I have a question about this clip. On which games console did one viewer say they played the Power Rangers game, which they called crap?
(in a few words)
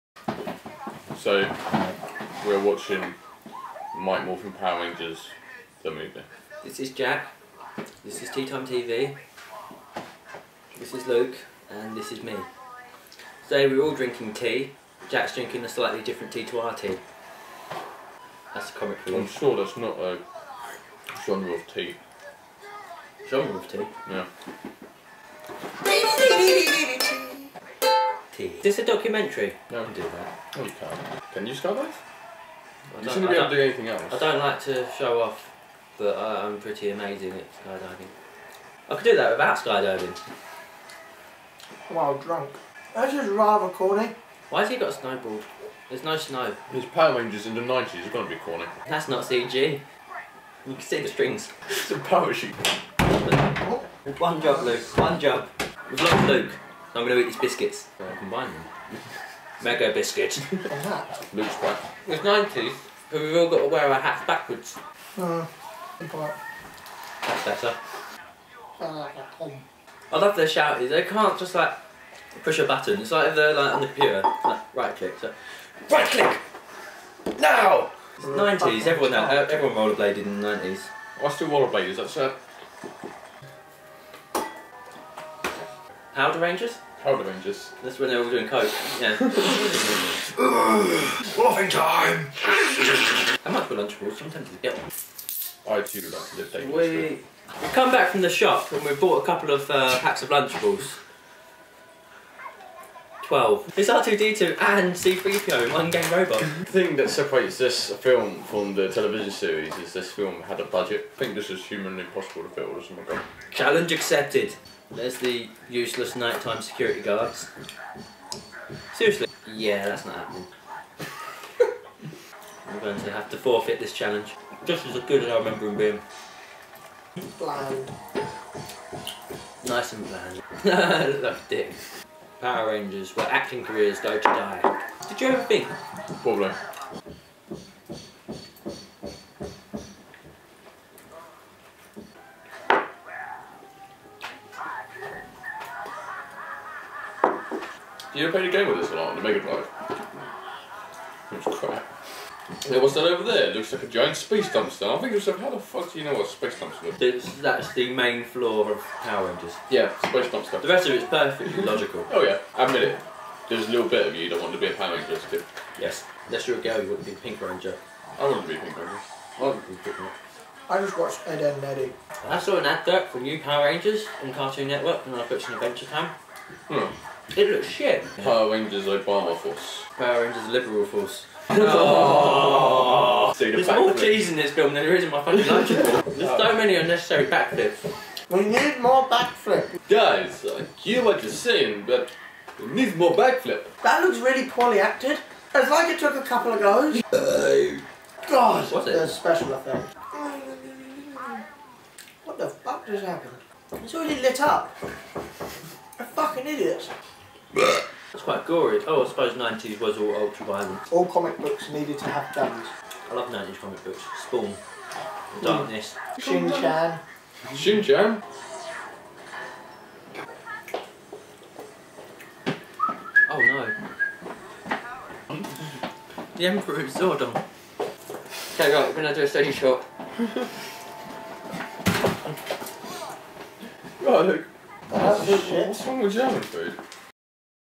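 Mega Drive.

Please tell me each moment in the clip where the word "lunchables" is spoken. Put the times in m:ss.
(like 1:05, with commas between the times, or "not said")
1:33, 1:40, 3:05.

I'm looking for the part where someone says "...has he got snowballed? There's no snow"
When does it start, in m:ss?
0:44.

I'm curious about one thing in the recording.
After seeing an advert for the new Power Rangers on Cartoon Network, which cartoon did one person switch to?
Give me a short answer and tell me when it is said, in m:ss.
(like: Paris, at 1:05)
Adventure Time, at 2:55.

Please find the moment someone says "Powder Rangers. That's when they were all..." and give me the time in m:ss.
1:27.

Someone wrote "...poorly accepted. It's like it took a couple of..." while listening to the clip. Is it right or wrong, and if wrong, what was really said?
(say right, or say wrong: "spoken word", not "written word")
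wrong: "acted", not "accepted".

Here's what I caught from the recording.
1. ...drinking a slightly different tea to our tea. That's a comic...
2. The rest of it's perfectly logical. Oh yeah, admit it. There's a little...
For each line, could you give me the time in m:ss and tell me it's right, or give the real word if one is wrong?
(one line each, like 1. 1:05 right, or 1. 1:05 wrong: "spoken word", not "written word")
1. 0:15 right
2. 2:40 right.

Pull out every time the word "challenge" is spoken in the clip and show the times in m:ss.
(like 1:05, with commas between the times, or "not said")
1:53, 2:03.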